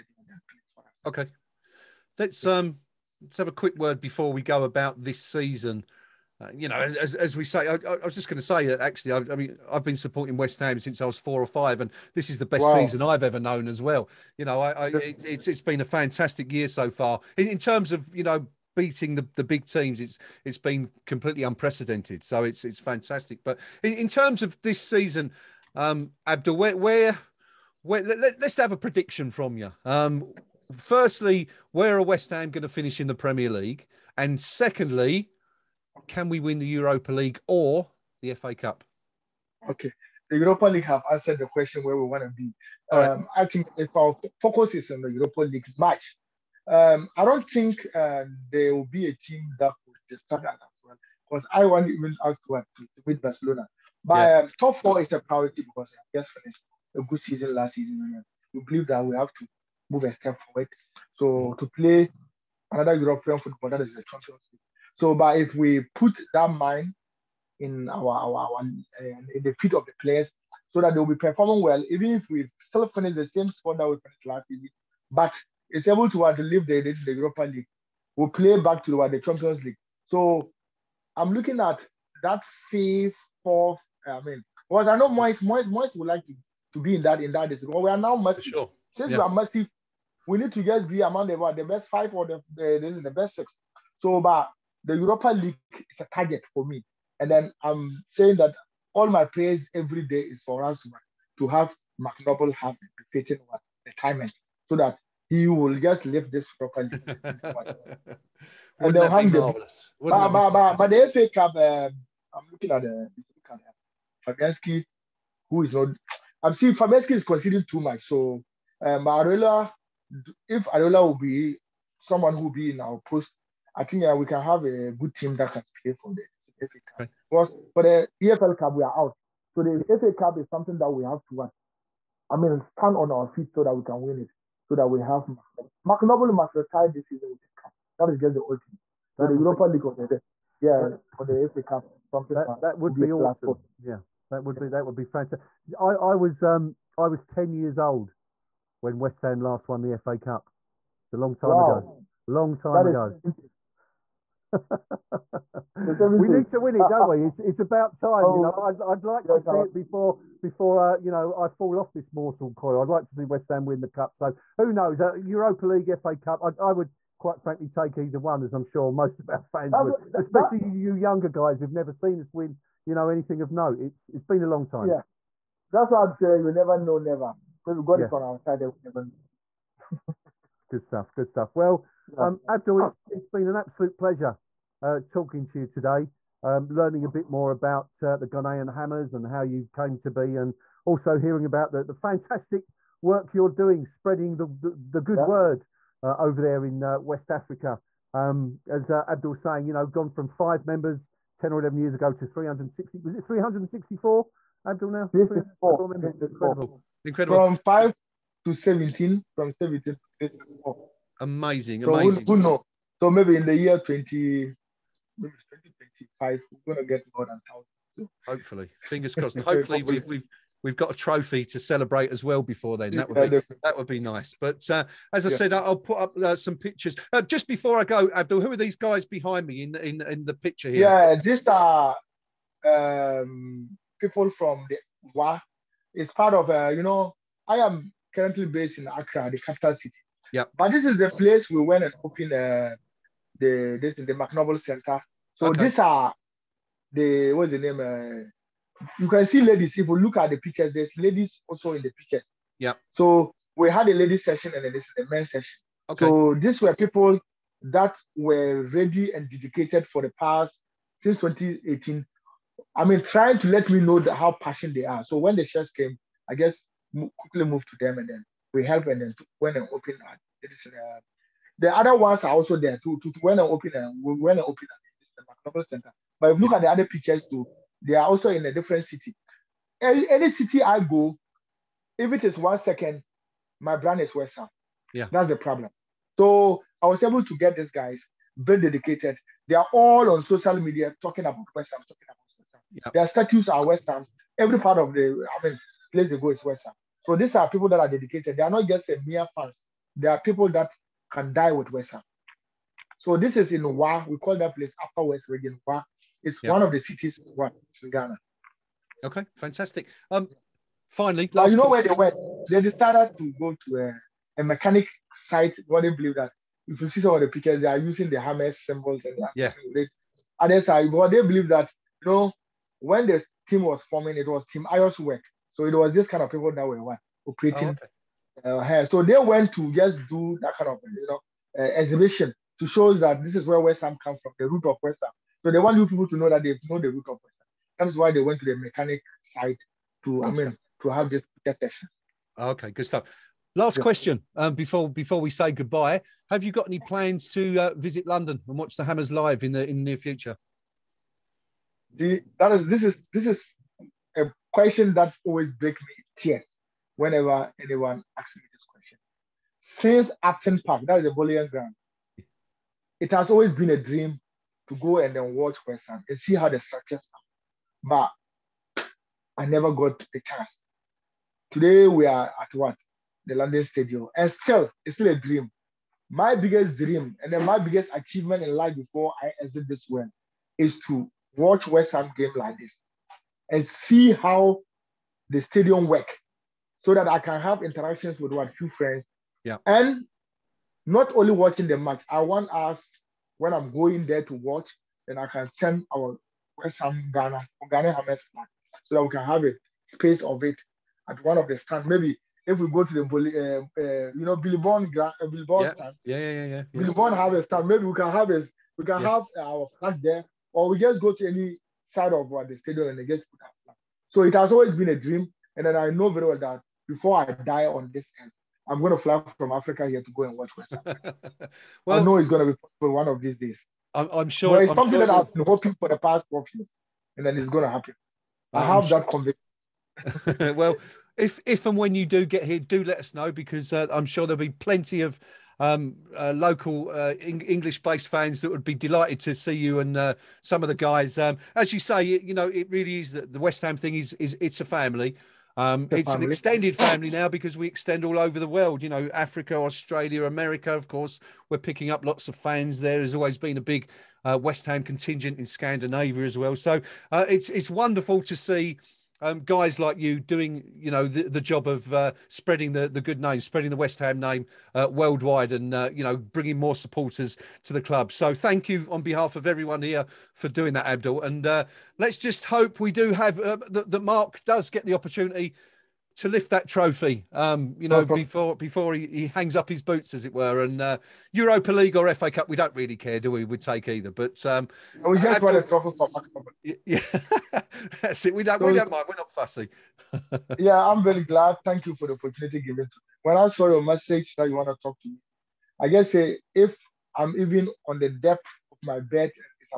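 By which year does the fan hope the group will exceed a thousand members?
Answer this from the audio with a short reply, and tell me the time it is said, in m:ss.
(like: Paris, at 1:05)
2025, at 3:35.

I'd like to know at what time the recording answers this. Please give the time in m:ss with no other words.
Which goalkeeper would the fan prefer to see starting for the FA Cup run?
2:00.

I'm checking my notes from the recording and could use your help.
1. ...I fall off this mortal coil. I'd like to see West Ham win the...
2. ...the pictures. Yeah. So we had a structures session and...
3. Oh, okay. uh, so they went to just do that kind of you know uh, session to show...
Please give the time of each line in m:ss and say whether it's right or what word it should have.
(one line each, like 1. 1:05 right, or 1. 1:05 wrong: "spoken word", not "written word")
1. 2:41 right
2. 4:11 wrong: "ladies", not "structures"
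3. 5:28 wrong: "exhibition", not "session".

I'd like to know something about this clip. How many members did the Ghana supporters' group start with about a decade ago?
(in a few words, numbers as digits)
5.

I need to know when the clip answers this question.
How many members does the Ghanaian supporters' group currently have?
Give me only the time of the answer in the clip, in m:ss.
3:25.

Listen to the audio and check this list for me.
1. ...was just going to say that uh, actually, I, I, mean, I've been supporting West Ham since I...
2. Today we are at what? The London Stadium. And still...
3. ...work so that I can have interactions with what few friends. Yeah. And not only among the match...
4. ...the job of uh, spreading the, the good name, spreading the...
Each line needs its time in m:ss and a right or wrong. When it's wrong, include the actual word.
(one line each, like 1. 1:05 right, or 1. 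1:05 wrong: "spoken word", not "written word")
1. 0:08 right
2. 6:11 right
3. 6:25 wrong: "watching", not "among"
4. 7:41 right.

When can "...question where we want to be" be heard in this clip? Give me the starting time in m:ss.
0:41.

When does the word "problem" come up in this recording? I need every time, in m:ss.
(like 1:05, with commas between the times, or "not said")
4:45.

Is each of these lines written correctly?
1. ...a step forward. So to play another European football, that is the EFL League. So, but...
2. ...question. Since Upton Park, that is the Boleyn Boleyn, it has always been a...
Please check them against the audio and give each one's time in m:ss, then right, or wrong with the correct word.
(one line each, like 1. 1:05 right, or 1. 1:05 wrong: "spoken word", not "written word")
1. 1:00 wrong: "Champions", not "EFL"
2. 5:58 wrong: "Ground", not "Boleyn".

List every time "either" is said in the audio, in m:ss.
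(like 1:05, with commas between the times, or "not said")
2:47, 8:03.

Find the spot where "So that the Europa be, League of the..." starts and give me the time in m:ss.
2:19.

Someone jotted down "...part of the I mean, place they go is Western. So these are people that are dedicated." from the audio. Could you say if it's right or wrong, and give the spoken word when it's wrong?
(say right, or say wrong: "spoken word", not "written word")
right.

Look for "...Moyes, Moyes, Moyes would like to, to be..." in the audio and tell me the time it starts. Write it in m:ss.
1:25.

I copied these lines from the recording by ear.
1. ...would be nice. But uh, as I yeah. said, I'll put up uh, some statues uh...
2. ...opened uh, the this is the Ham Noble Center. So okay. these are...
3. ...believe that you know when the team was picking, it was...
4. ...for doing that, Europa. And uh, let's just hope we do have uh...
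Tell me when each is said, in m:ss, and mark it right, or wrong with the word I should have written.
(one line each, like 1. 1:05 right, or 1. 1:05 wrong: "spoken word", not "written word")
1. 3:43 wrong: "pictures", not "statues"
2. 4:02 wrong: "Mark", not "Ham"
3. 5:21 wrong: "forming", not "picking"
4. 7:50 wrong: "Abdul", not "Europa".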